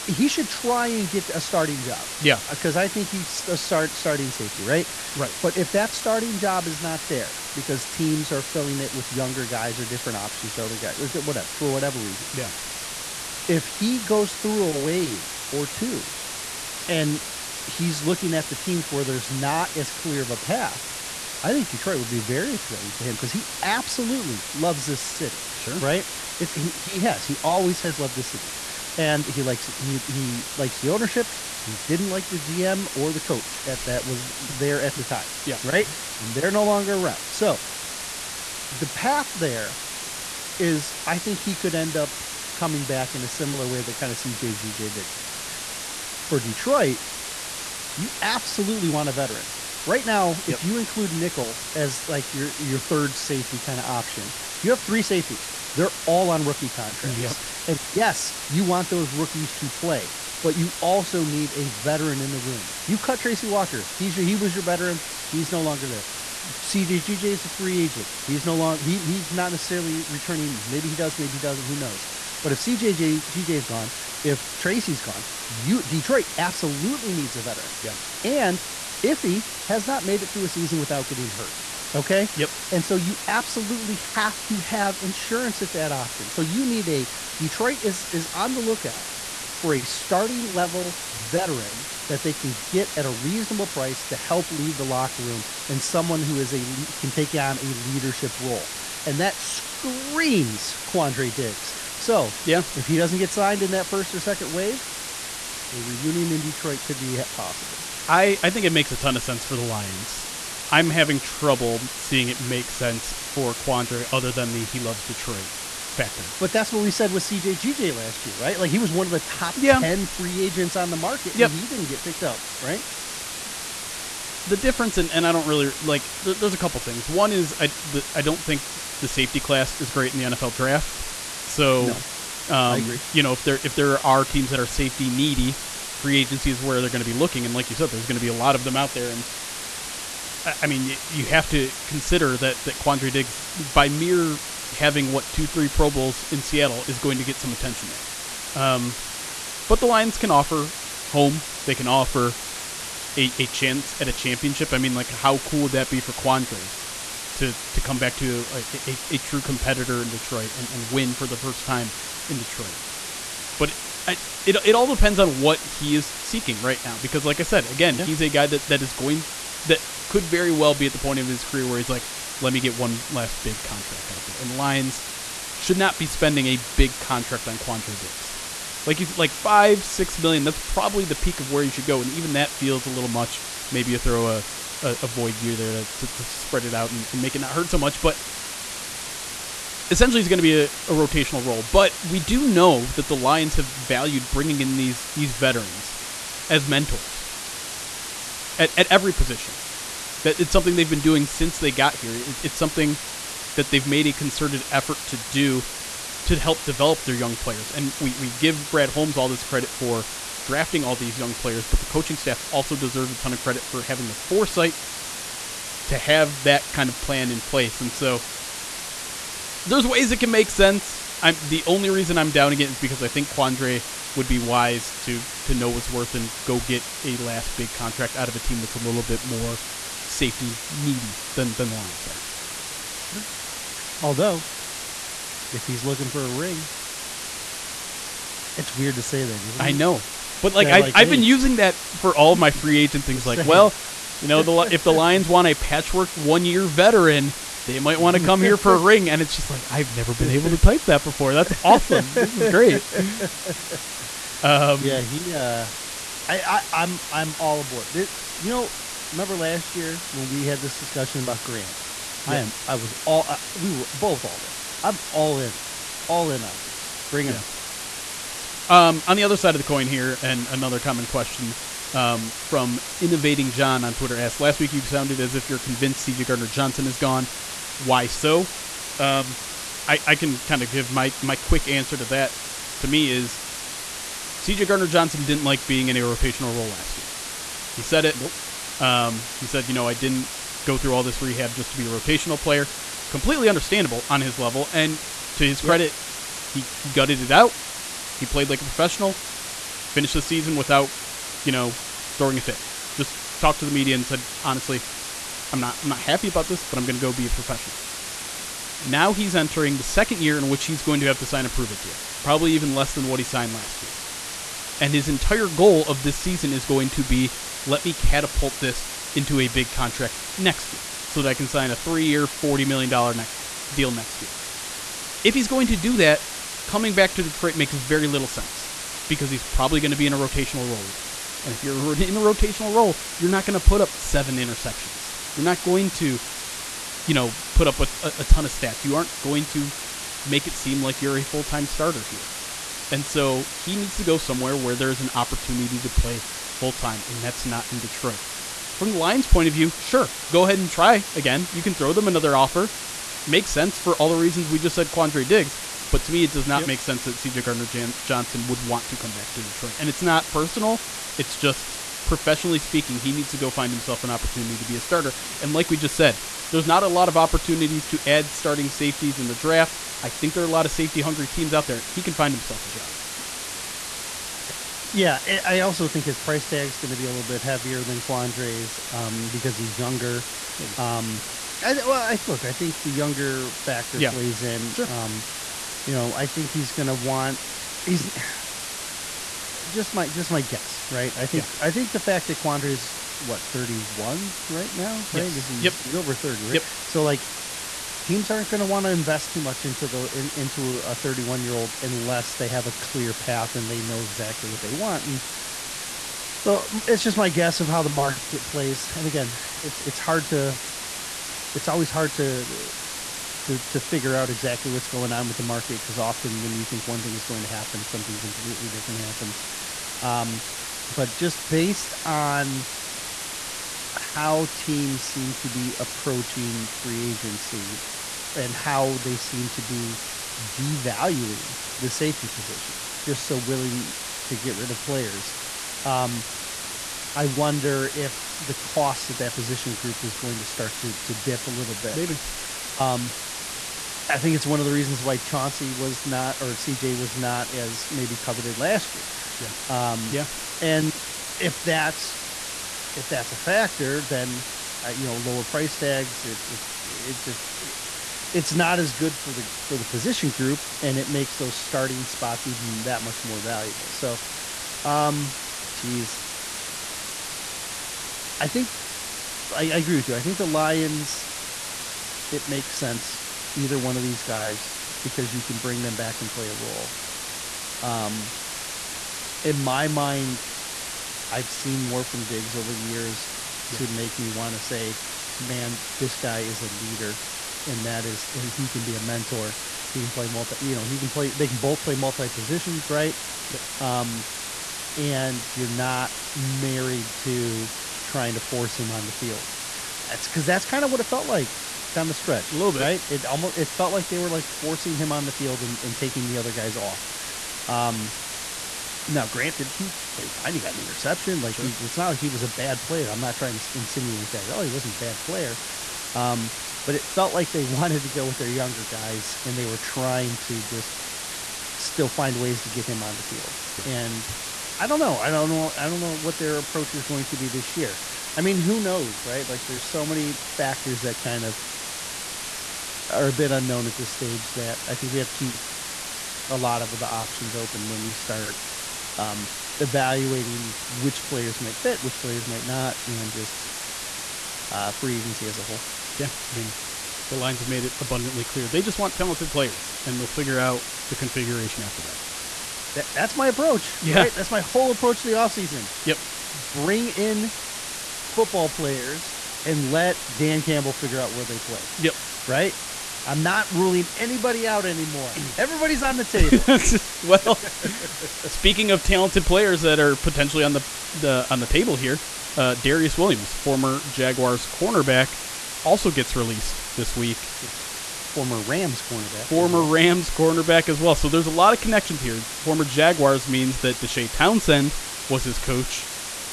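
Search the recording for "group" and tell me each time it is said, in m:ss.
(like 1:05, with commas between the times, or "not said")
7:19, 7:40.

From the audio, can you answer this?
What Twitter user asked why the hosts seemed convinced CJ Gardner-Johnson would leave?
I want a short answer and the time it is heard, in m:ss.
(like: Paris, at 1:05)
Innovating John, at 4:32.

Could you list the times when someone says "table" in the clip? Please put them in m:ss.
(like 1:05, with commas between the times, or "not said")
9:26, 9:31.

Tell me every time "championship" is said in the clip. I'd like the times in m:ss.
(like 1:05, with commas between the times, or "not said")
2:34.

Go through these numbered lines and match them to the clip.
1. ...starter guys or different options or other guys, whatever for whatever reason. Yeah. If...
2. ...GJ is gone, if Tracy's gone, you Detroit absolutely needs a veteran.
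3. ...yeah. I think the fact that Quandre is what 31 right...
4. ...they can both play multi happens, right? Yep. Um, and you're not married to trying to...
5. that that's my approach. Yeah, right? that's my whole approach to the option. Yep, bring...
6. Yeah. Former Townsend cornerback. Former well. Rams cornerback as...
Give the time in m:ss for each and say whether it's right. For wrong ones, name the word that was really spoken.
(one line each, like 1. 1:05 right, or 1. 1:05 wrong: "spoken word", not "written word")
1. 0:09 wrong: "younger", not "starter"
2. 1:13 right
3. 6:31 right
4. 8:11 wrong: "positions", not "happens"
5. 9:12 wrong: "offseason", not "option"
6. 9:37 wrong: "Rams", not "Townsend".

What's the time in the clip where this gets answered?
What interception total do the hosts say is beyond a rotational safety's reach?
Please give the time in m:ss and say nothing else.
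5:33.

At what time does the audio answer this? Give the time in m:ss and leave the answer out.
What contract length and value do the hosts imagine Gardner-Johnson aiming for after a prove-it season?
5:21.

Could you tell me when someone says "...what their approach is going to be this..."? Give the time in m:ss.
8:46.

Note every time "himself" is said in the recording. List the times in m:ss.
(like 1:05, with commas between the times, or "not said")
6:03, 6:12.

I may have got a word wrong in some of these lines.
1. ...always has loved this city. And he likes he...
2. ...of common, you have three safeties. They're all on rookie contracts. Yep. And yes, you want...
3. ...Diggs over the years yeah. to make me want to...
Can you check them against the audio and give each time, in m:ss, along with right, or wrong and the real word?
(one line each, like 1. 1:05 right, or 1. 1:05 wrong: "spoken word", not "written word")
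1. 0:27 right
2. 0:53 wrong: "option", not "common"
3. 8:02 right.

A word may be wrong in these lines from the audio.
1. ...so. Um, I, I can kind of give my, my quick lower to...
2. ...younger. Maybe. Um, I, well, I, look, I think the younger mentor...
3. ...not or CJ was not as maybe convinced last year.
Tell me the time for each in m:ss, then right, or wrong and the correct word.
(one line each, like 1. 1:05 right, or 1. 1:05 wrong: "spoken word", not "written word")
1. 4:38 wrong: "answer", not "lower"
2. 6:19 wrong: "factor", not "mentor"
3. 7:26 wrong: "coveted", not "convinced".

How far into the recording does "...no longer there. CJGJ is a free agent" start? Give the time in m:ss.
1:05.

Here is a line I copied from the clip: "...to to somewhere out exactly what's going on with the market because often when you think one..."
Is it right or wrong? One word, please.
wrong.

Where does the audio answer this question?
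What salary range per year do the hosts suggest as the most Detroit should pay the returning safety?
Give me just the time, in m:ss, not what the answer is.
2:59.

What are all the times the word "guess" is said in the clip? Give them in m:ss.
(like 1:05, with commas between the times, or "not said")
6:30, 6:47.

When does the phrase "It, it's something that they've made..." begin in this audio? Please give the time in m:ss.
3:22.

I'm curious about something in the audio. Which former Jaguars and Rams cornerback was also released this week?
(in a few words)
Darious Williams.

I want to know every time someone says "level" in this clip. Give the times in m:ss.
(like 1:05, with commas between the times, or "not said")
1:30, 4:54.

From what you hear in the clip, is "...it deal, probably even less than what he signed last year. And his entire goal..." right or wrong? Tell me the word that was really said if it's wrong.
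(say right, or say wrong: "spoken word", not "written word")
right.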